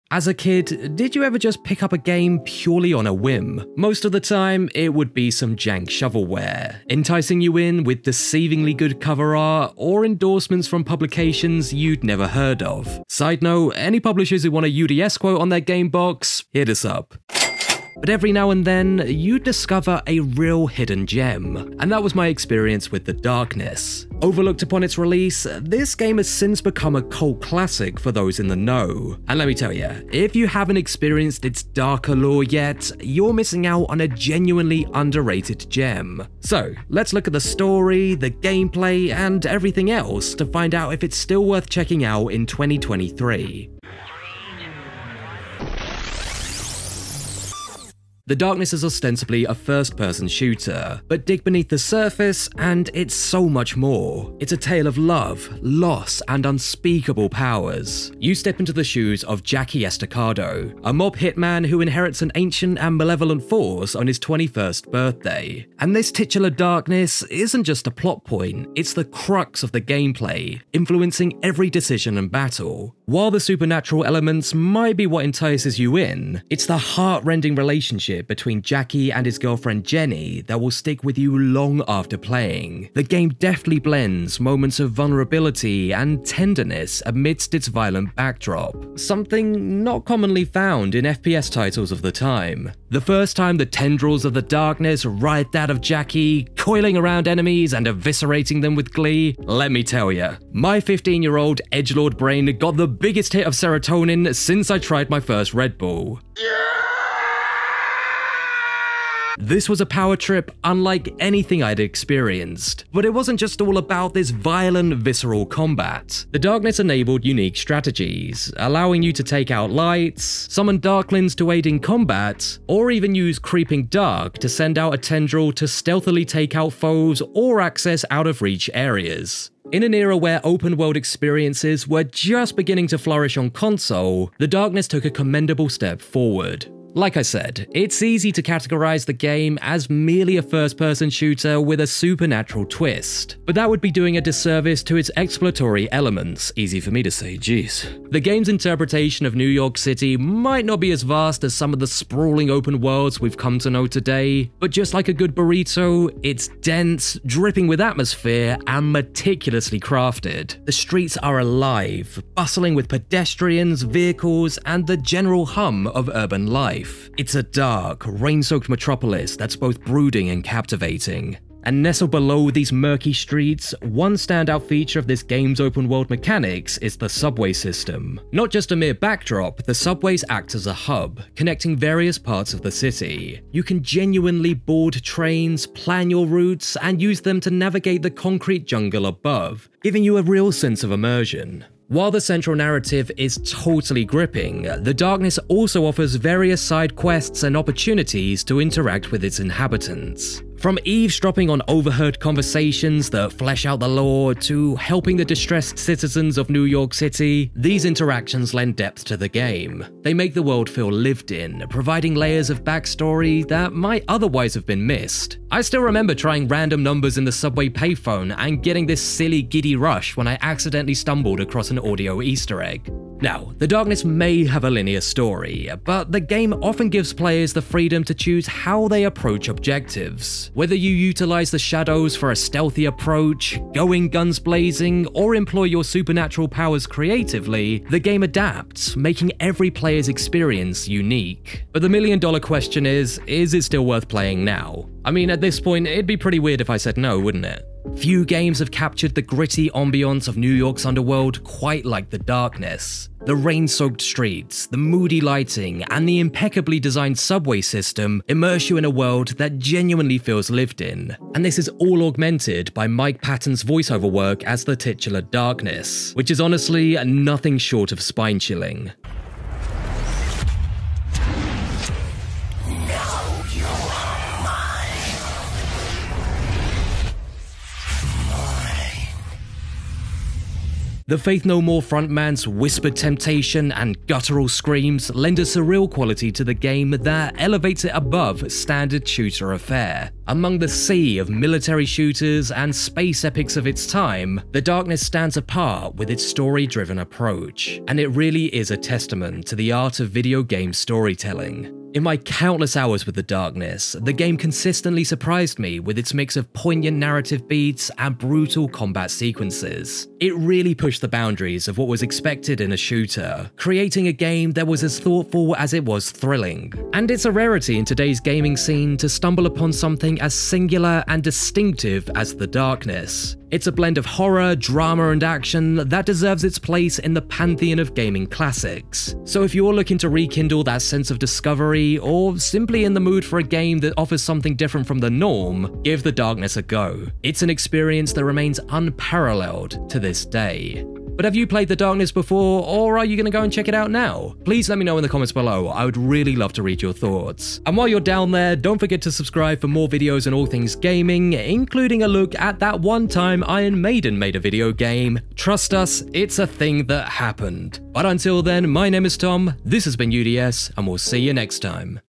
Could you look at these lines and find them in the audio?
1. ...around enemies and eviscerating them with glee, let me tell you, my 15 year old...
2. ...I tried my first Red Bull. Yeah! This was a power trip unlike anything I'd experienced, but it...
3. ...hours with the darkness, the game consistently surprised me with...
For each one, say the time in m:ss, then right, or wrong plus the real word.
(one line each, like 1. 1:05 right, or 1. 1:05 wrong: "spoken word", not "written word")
1. 1:36 right
2. 1:44 right
3. 5:02 right.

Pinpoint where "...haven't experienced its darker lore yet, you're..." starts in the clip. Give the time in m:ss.
0:30.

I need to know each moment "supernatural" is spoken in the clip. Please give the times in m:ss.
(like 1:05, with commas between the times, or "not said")
1:13, 2:21, 3:55.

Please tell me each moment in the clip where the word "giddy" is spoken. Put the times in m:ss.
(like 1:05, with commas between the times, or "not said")
3:39.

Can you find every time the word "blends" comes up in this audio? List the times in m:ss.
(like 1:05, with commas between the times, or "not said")
1:23, 5:23.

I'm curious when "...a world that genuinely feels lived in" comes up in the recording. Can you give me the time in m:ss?
4:18.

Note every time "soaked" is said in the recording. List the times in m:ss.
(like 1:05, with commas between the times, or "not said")
2:48, 4:13.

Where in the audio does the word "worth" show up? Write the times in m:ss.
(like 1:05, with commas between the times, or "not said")
0:41, 4:03.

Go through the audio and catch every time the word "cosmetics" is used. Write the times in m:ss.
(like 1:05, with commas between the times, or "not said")
not said.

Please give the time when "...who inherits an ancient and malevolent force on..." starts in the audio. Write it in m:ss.
1:01.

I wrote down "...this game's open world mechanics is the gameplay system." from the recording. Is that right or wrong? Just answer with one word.
wrong.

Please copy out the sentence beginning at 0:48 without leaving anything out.
The Darkness is ostensibly a first person shooter, but dig beneath the surface and it's so much more.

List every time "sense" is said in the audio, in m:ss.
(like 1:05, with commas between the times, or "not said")
3:10, 5:30.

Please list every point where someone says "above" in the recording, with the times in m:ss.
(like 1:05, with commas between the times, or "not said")
3:09, 4:47.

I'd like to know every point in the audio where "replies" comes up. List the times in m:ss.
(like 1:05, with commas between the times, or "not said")
not said.